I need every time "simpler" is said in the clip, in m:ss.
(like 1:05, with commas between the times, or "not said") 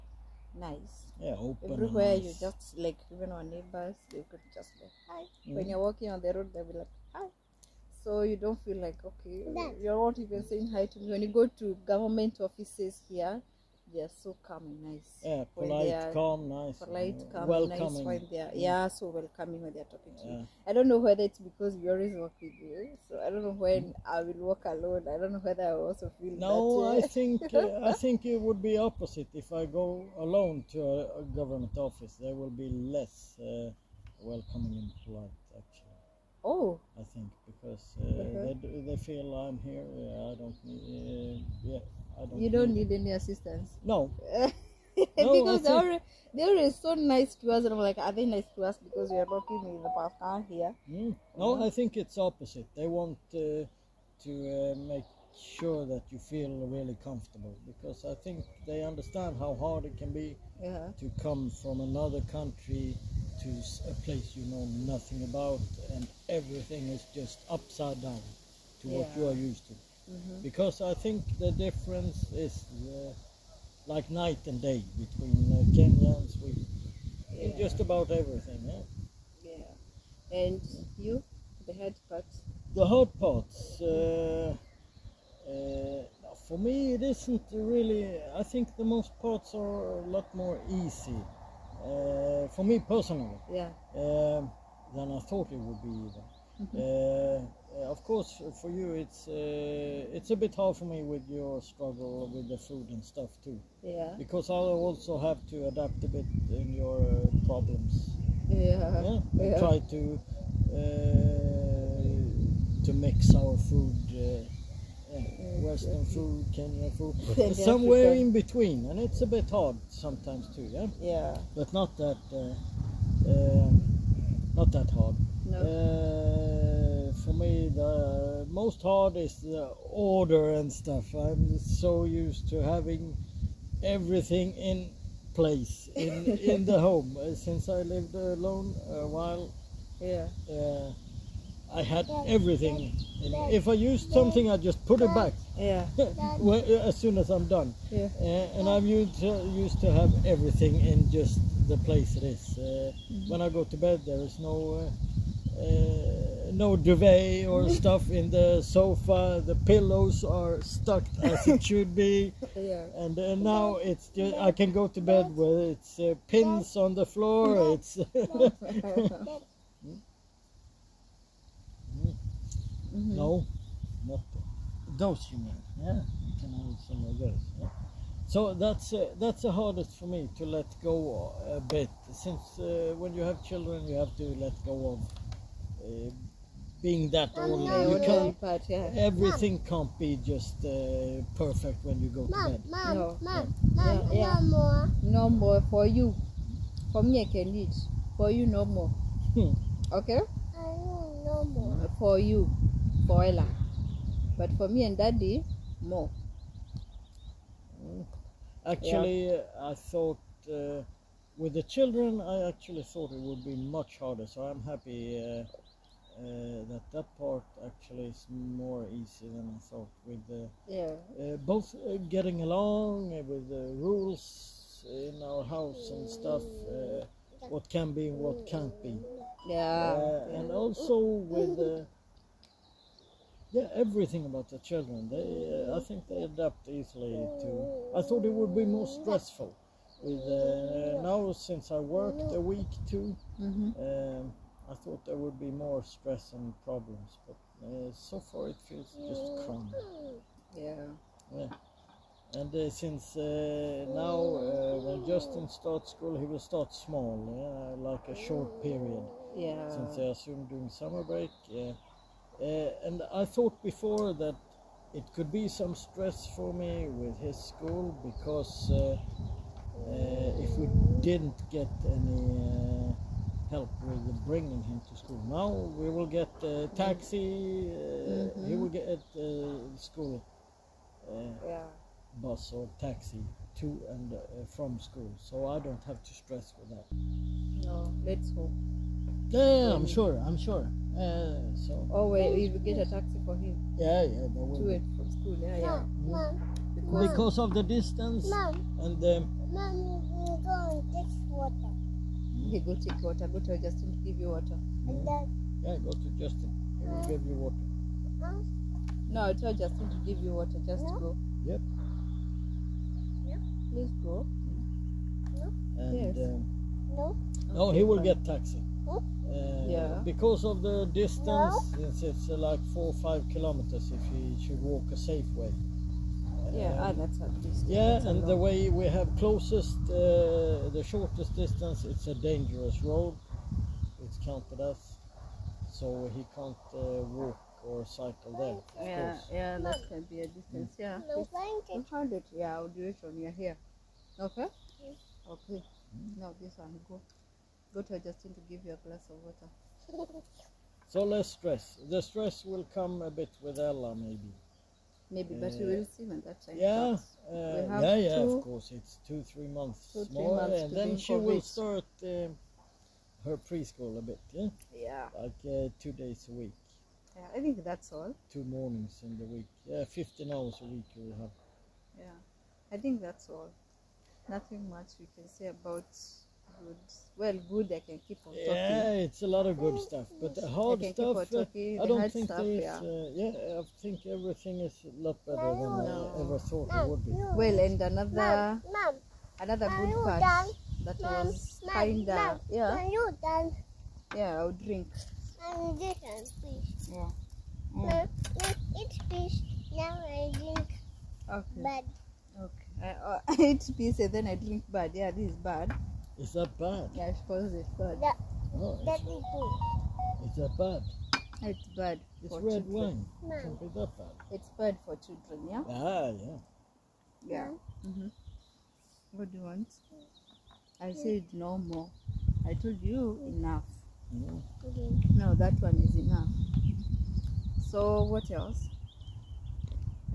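not said.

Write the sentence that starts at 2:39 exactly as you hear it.
The pillows are stuck as it should be.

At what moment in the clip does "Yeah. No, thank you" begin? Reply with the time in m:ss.
5:40.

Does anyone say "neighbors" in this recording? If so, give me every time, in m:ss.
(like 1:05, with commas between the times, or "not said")
0:03.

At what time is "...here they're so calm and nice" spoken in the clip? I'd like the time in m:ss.
0:13.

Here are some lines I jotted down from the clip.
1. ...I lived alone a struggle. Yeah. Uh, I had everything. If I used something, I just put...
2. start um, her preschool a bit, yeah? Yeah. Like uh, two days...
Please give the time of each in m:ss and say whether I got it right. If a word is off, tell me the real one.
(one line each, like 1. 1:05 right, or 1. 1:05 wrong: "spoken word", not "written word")
1. 2:17 wrong: "while", not "struggle"
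2. 6:01 right.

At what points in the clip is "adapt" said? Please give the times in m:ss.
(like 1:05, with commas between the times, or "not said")
1:45, 3:56.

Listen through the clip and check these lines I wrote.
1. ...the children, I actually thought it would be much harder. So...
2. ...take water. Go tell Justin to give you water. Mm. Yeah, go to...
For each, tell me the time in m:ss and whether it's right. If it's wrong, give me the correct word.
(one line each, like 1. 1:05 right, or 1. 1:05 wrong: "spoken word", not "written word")
1. 3:31 right
2. 5:02 right.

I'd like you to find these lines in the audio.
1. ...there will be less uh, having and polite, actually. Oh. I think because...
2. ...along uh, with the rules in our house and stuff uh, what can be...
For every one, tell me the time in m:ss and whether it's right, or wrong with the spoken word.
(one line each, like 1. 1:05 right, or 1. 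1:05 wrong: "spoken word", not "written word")
1. 0:32 wrong: "welcoming", not "having"
2. 3:42 right.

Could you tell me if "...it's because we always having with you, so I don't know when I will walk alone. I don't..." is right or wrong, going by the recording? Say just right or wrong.
wrong.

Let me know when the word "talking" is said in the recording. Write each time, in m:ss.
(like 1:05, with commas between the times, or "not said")
0:19, 6:18.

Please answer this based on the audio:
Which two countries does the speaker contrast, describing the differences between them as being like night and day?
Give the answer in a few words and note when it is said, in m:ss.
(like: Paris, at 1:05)
Kenya and Sweden, at 1:15.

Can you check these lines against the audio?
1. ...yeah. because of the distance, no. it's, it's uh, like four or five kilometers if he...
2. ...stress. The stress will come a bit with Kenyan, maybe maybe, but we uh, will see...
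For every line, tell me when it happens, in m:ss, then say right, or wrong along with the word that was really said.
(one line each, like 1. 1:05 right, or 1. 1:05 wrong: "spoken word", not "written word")
1. 5:19 right
2. 5:51 wrong: "Ella", not "Kenyan".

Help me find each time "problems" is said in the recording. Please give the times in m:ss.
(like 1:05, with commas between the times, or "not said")
1:47, 4:06.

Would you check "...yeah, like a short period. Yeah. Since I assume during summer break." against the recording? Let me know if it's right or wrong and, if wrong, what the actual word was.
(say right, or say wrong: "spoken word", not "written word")
right.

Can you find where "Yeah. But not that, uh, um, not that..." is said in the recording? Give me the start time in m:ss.
2:00.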